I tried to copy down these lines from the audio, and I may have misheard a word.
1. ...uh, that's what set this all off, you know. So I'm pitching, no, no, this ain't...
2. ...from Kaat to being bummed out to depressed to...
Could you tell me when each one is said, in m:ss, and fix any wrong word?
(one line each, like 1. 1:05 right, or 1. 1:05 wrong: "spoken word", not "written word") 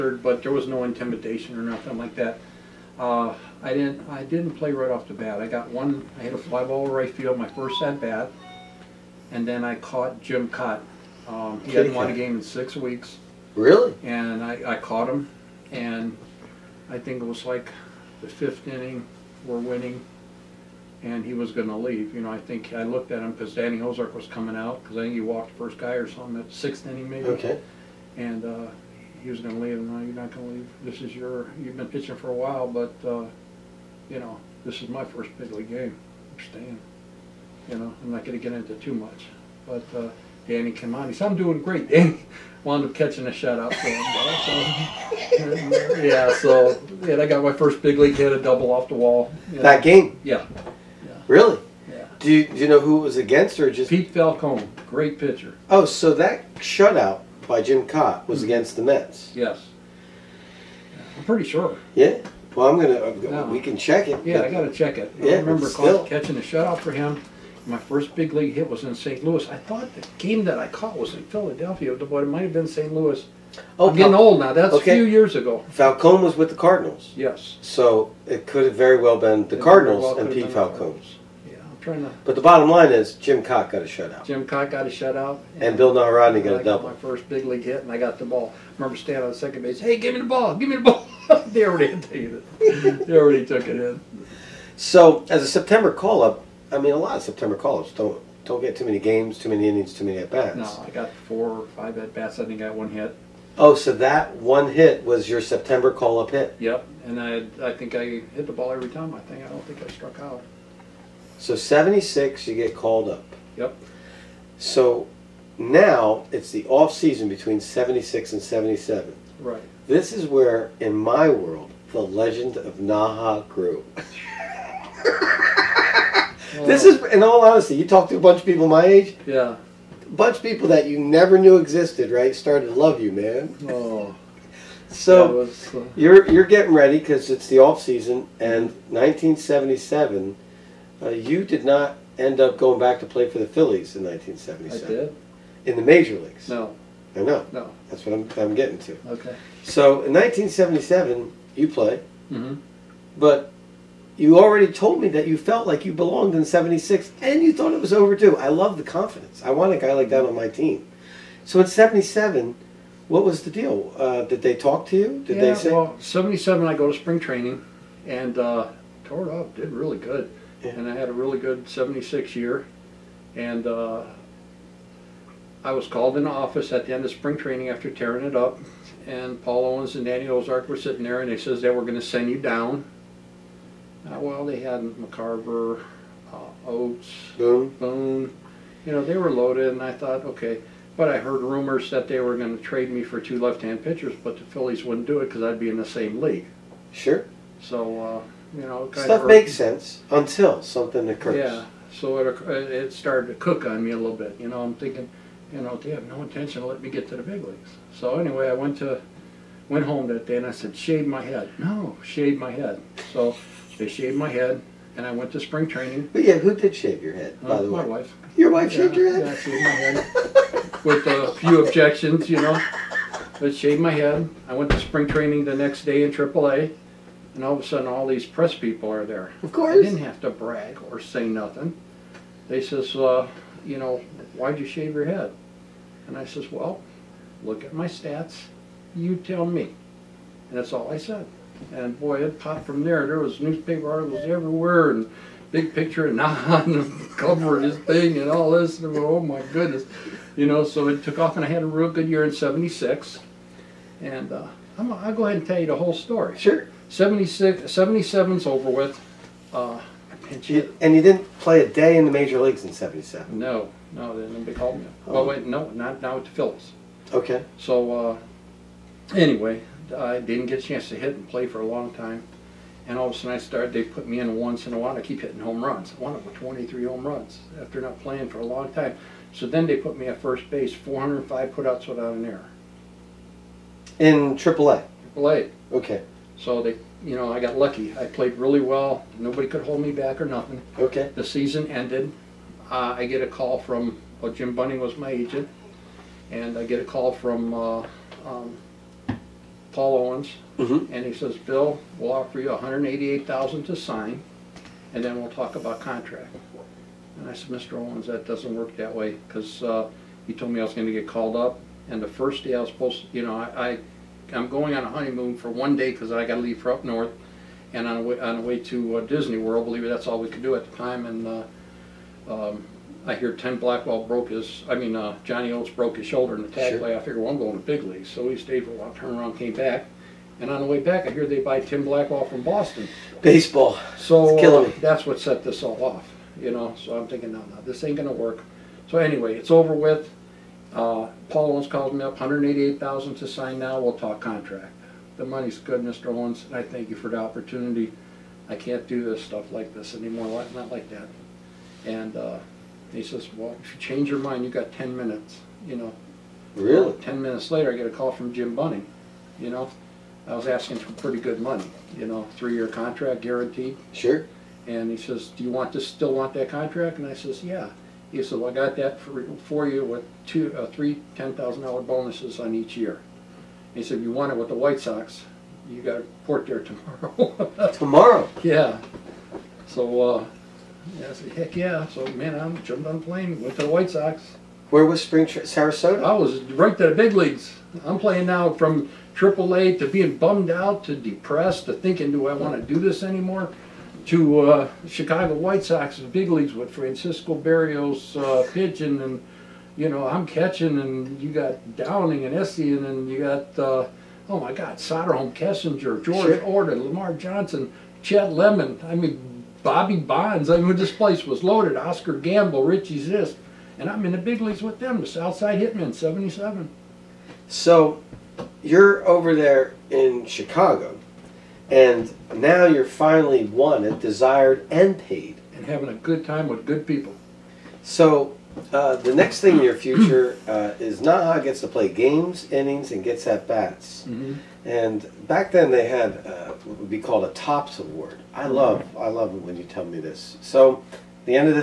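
1. 5:34 wrong: "thinking", not "pitching"
2. 6:28 wrong: "AAA", not "Kaat".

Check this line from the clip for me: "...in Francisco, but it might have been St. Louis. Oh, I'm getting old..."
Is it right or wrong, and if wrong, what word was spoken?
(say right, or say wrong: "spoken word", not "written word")
wrong: "Philadelphia", not "Francisco".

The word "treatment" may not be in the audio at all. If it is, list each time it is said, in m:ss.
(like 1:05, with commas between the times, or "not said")
not said.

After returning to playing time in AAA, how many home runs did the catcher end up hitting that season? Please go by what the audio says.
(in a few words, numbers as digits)
23.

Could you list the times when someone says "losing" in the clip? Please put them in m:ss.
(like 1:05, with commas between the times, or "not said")
not said.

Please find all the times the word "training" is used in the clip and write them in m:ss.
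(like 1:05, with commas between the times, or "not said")
2:47, 2:57, 3:35, 3:45.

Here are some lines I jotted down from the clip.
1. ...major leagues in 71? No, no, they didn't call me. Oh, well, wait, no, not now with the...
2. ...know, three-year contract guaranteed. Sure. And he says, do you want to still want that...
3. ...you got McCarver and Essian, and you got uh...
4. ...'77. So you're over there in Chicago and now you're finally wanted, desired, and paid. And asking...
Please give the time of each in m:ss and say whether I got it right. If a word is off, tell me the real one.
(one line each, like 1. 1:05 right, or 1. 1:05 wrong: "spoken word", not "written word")
1. 4:22 wrong: "77", not "71"
2. 6:02 right
3. 6:41 wrong: "Downing", not "McCarver"
4. 6:55 wrong: "having", not "asking".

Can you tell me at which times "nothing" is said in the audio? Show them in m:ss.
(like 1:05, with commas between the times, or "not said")
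0:01, 3:51, 4:50.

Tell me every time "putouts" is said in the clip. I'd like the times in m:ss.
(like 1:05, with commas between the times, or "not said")
4:41.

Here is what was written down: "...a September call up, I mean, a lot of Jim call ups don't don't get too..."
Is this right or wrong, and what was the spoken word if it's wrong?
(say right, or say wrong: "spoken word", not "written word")
wrong: "September", not "Jim".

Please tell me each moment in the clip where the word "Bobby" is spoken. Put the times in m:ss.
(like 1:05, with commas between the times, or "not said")
6:49.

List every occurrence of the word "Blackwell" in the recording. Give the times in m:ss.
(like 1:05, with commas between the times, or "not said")
5:23, 5:31.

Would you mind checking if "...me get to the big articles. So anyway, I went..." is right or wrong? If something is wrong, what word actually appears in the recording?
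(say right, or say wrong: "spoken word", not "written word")
wrong: "leagues", not "articles".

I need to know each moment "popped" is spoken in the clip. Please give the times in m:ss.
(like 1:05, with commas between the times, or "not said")
4:02.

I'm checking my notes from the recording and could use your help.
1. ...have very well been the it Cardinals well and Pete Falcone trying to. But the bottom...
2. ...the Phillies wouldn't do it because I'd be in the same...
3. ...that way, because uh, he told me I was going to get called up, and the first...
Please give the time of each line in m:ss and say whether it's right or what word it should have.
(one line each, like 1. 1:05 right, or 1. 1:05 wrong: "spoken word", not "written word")
1. 1:18 right
2. 3:14 right
3. 5:08 right.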